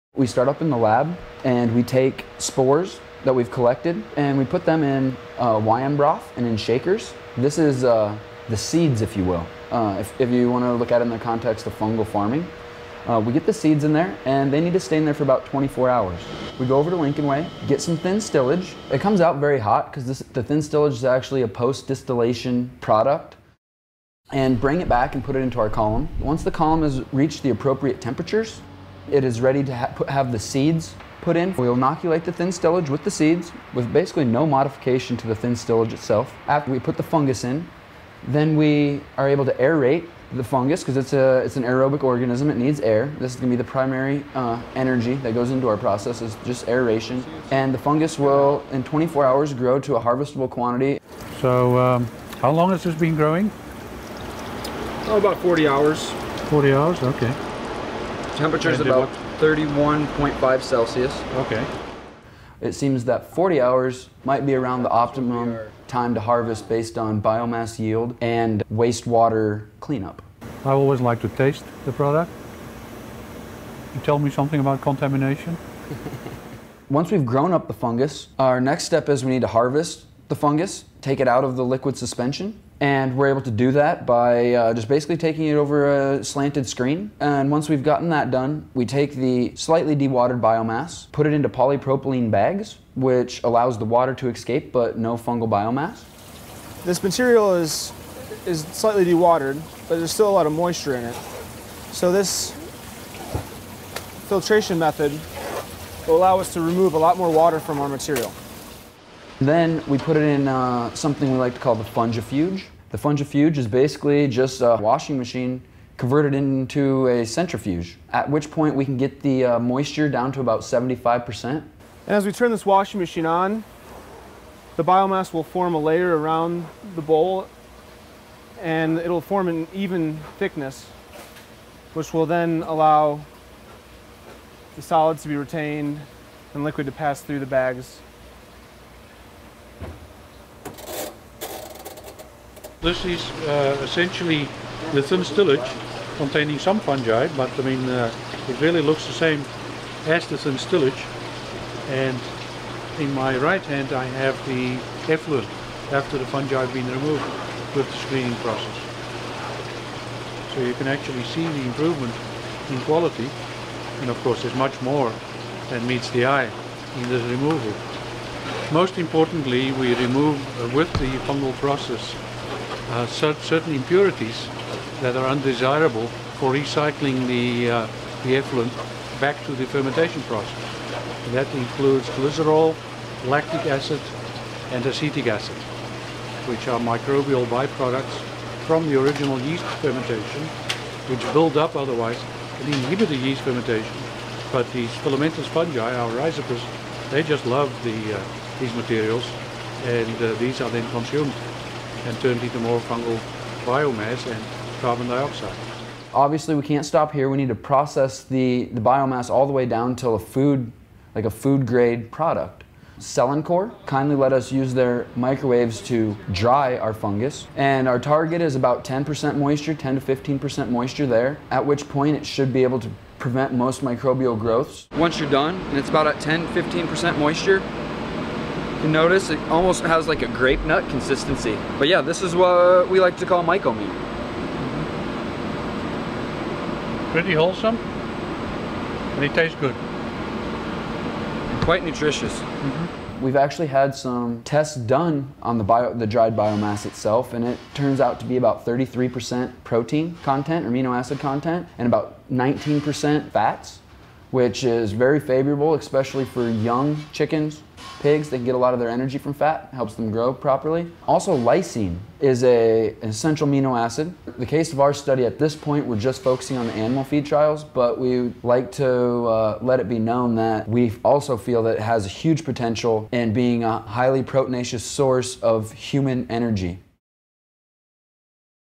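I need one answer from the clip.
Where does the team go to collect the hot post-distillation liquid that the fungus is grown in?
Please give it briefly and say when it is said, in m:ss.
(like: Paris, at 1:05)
Lincoln Way, at 0:16.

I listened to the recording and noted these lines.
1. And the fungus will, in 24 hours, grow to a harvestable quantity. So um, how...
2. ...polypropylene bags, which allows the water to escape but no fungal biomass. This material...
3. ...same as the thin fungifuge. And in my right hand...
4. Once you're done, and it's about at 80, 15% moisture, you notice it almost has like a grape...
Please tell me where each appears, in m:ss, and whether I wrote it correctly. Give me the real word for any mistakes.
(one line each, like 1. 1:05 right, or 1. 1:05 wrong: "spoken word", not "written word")
1. 0:47 right
2. 1:31 right
3. 2:29 wrong: "stillage", not "fungifuge"
4. 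3:44 wrong: "10", not "80".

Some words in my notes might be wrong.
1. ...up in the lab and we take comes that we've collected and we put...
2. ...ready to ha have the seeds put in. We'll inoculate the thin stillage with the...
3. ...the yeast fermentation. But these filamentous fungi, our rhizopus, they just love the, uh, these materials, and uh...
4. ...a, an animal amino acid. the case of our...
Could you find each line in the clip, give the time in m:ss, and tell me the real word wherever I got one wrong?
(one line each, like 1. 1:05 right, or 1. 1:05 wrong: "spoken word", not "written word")
1. 0:00 wrong: "spores", not "comes"
2. 0:29 right
3. 3:13 right
4. 4:22 wrong: "essential", not "animal".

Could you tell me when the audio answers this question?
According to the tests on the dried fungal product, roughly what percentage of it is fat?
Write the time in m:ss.
4:12.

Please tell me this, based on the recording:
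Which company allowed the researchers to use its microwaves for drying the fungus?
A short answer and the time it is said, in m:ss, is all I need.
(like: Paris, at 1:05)
Cellencor, at 3:32.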